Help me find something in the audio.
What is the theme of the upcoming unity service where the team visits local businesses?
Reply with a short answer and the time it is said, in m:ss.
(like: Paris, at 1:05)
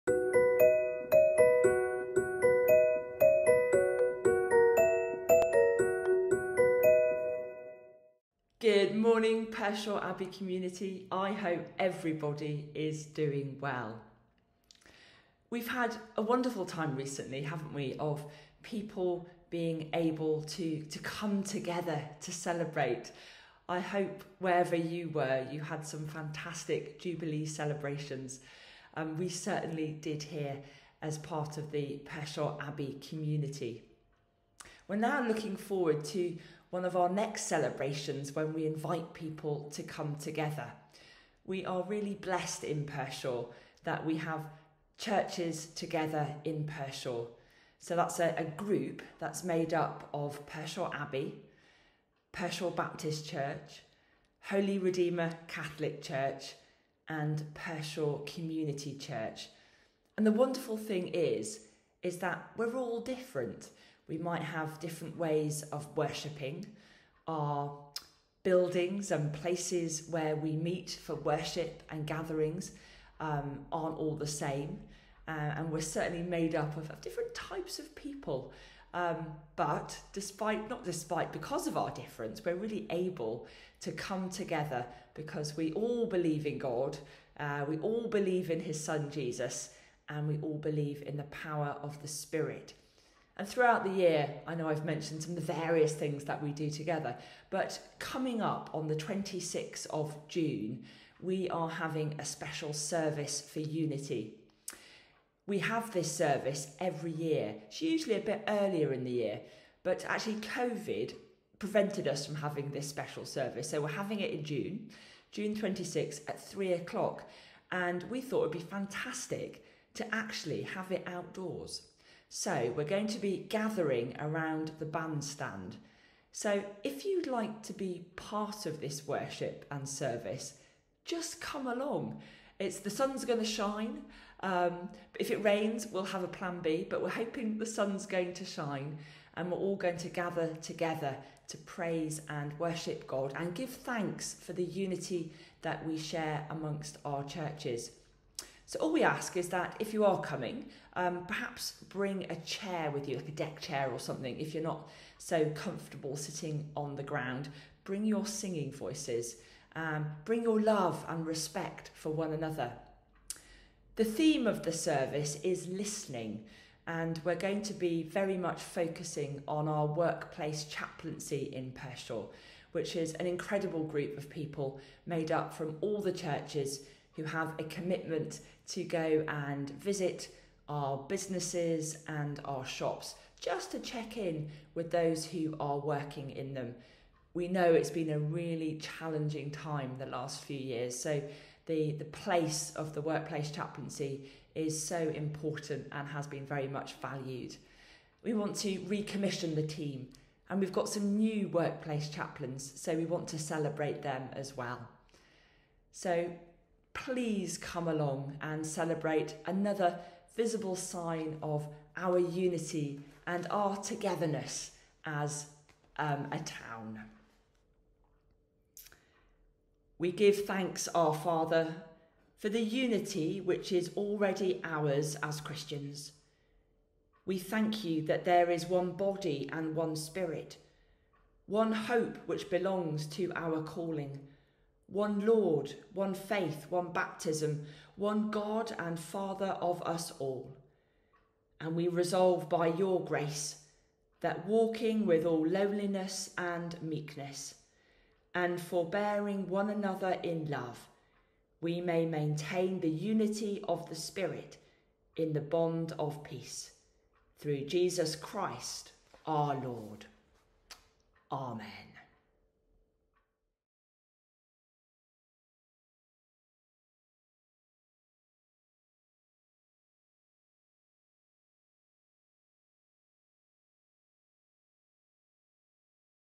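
Listening, at 2:45.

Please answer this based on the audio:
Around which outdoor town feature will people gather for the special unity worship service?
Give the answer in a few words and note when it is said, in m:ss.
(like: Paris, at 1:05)
The bandstand, at 2:04.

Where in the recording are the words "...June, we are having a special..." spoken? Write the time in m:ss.
1:40.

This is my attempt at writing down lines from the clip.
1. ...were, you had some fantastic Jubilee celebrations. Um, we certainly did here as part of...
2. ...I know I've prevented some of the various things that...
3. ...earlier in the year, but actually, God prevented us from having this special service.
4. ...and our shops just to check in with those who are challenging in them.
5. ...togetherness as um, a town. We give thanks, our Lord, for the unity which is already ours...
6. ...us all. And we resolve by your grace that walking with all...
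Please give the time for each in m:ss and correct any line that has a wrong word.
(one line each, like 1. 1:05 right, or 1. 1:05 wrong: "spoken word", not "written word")
1. 0:25 right
2. 1:34 wrong: "mentioned", not "prevented"
3. 1:48 wrong: "COVID", not "God"
4. 3:02 wrong: "working", not "challenging"
5. 3:33 wrong: "Father", not "Lord"
6. 3:59 right.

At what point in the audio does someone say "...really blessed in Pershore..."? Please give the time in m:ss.
0:41.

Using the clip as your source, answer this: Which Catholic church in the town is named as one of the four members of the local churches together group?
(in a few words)
Holy Redeemer Catholic Church.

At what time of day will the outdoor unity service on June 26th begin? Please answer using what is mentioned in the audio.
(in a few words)
3 o'clock.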